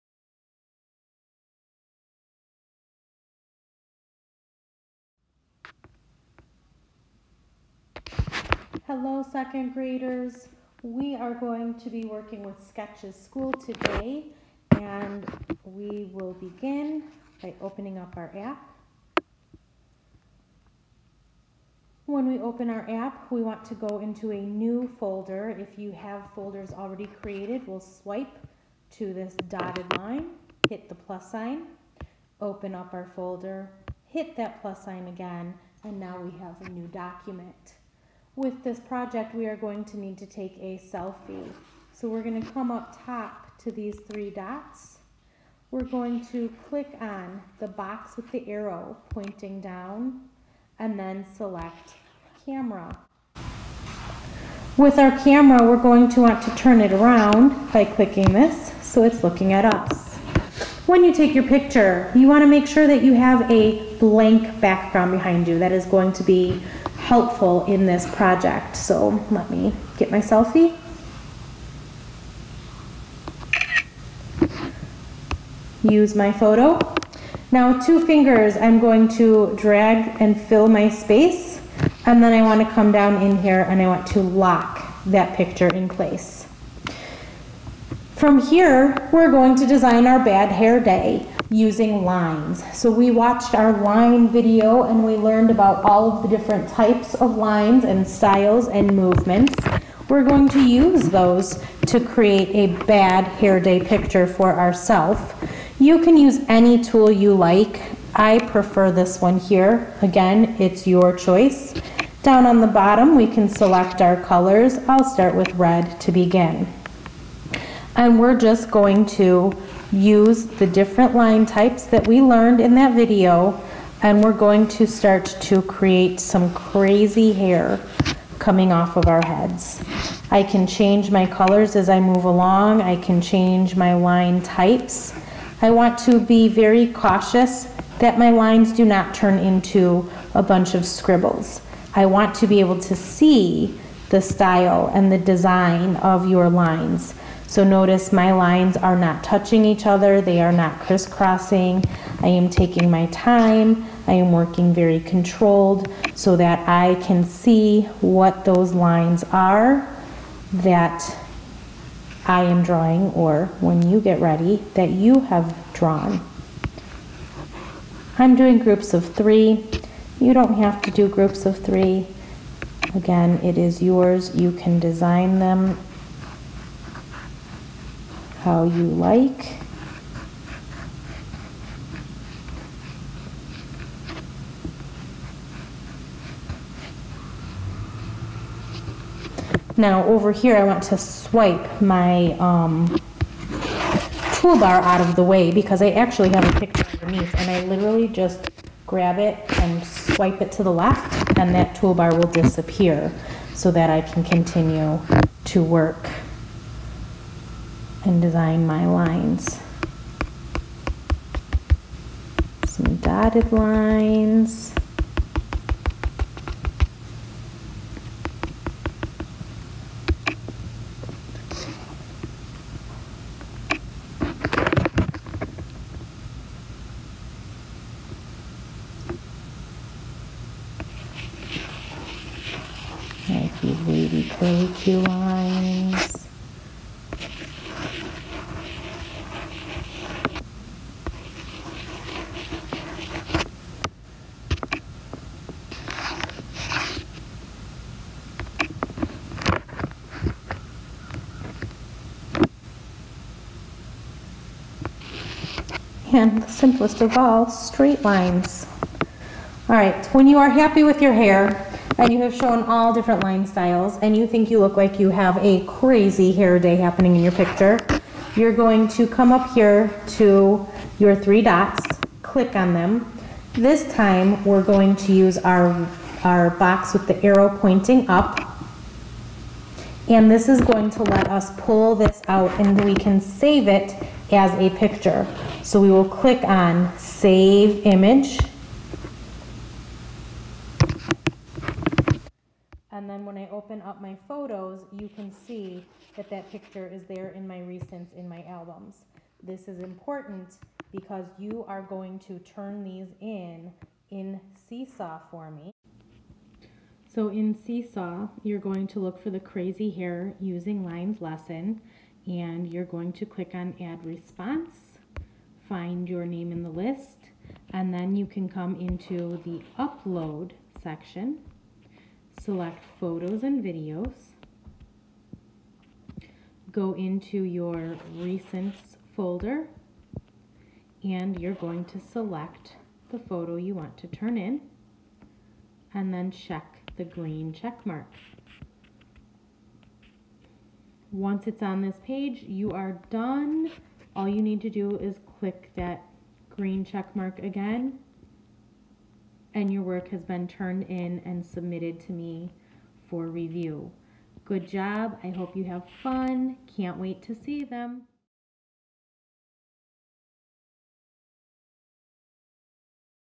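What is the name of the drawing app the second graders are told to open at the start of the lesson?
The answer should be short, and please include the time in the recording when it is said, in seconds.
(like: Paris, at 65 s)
Sketches School, at 12 s.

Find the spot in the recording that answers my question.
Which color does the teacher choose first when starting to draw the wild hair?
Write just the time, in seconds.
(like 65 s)
115 s.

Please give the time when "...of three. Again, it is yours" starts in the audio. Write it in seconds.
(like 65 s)
171 s.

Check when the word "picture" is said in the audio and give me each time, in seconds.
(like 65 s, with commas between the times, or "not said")
61 s, 85 s, 103 s, 196 s, 267 s, 284 s, 296 s.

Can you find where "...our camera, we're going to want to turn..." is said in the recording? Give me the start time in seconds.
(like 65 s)
54 s.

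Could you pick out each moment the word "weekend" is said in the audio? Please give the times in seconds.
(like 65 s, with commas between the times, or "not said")
not said.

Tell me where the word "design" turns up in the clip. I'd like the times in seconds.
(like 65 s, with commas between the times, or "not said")
89 s, 145 s, 174 s, 208 s.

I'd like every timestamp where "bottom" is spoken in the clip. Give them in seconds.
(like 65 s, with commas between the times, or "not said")
112 s.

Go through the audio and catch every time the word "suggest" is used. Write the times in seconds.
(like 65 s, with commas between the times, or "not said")
not said.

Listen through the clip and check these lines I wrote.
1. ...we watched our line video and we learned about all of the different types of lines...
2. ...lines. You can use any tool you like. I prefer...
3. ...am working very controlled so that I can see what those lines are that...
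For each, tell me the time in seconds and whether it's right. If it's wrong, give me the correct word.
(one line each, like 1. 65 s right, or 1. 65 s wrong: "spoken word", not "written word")
1. 92 s right
2. 104 s wrong: "ourselves", not "lines"
3. 154 s right.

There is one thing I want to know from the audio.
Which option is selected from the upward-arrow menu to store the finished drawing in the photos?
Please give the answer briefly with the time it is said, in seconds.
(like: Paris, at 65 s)
Save Image, at 286 s.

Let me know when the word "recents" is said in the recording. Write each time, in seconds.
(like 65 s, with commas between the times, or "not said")
297 s, 328 s.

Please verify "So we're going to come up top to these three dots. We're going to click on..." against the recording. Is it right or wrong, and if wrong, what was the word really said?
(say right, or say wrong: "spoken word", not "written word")
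right.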